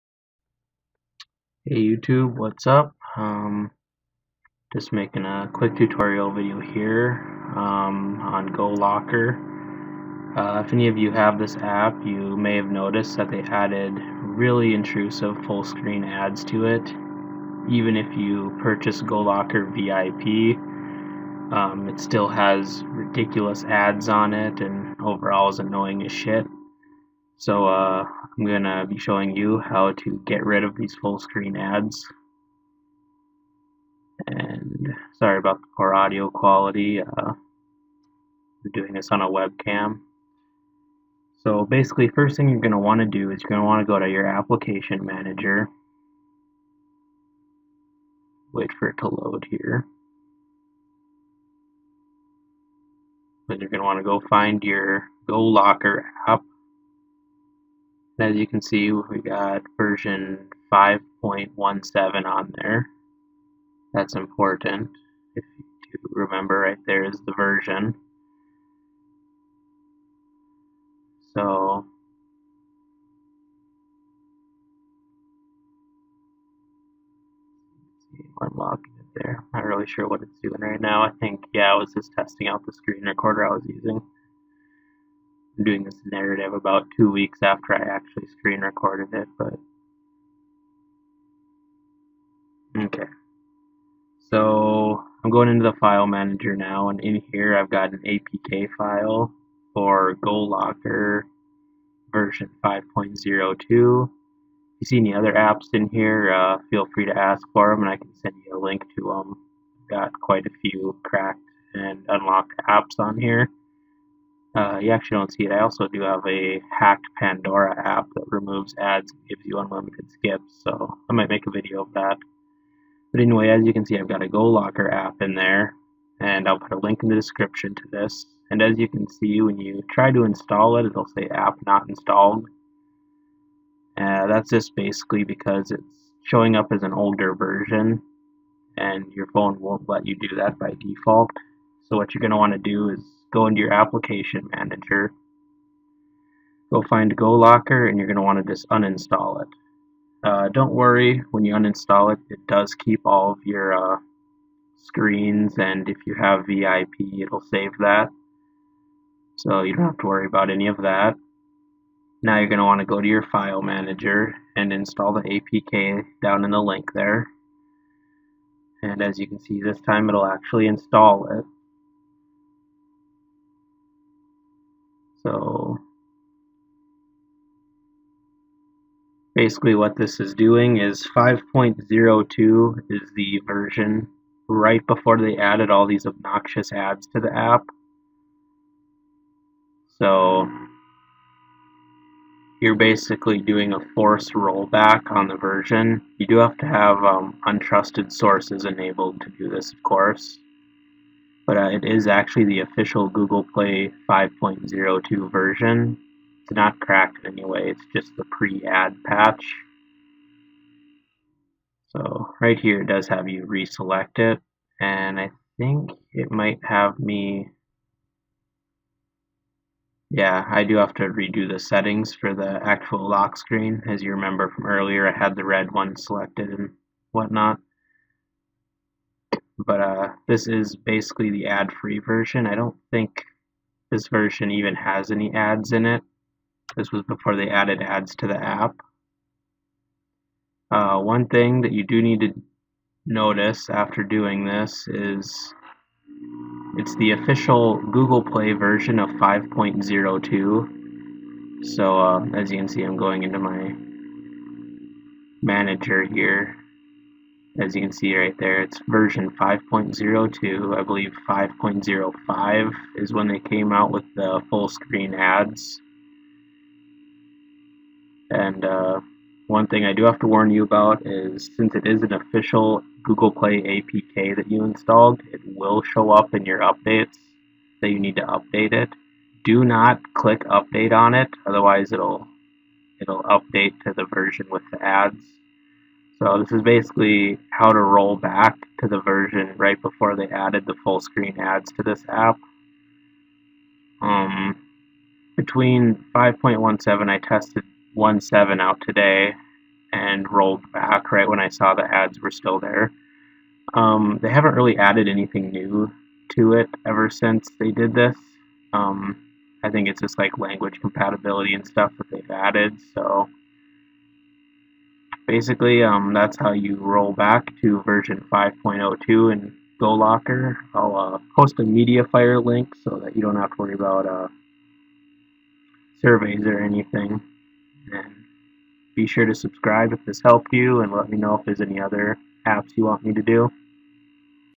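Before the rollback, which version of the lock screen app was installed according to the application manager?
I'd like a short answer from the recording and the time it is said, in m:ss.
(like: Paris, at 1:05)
5.17, at 0:59.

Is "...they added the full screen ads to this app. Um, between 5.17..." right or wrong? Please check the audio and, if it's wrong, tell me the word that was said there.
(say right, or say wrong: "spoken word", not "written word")
right.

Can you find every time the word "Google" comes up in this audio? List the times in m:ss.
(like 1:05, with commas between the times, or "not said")
3:23, 4:07, 4:33.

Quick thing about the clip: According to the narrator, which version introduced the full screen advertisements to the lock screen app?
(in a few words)
5.05.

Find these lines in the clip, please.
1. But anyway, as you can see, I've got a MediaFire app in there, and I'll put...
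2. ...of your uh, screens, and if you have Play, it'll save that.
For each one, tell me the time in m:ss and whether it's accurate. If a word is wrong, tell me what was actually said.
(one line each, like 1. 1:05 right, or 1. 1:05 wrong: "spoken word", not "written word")
1. 2:03 wrong: "GoLocker", not "MediaFire"
2. 2:33 wrong: "VIP", not "Play".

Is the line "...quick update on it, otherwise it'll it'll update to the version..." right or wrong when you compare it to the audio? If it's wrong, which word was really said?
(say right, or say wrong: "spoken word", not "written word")
wrong: "click", not "quick".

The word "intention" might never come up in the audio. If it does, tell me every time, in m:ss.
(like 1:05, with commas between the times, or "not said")
not said.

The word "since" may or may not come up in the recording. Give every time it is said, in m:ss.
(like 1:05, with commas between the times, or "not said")
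4:31, 5:07.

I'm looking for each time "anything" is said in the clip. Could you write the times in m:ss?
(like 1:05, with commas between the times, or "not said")
5:05, 5:26.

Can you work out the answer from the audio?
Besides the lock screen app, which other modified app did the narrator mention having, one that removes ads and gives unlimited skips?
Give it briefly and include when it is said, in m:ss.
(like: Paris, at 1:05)
Pandora, at 1:57.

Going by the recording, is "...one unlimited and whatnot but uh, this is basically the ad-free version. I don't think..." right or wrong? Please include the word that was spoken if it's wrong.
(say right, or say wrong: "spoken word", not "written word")
wrong: "selected", not "unlimited".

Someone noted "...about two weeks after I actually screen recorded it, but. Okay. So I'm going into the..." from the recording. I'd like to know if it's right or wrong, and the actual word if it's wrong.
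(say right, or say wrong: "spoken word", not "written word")
right.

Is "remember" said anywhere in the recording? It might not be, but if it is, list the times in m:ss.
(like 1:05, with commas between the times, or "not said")
1:06, 3:44.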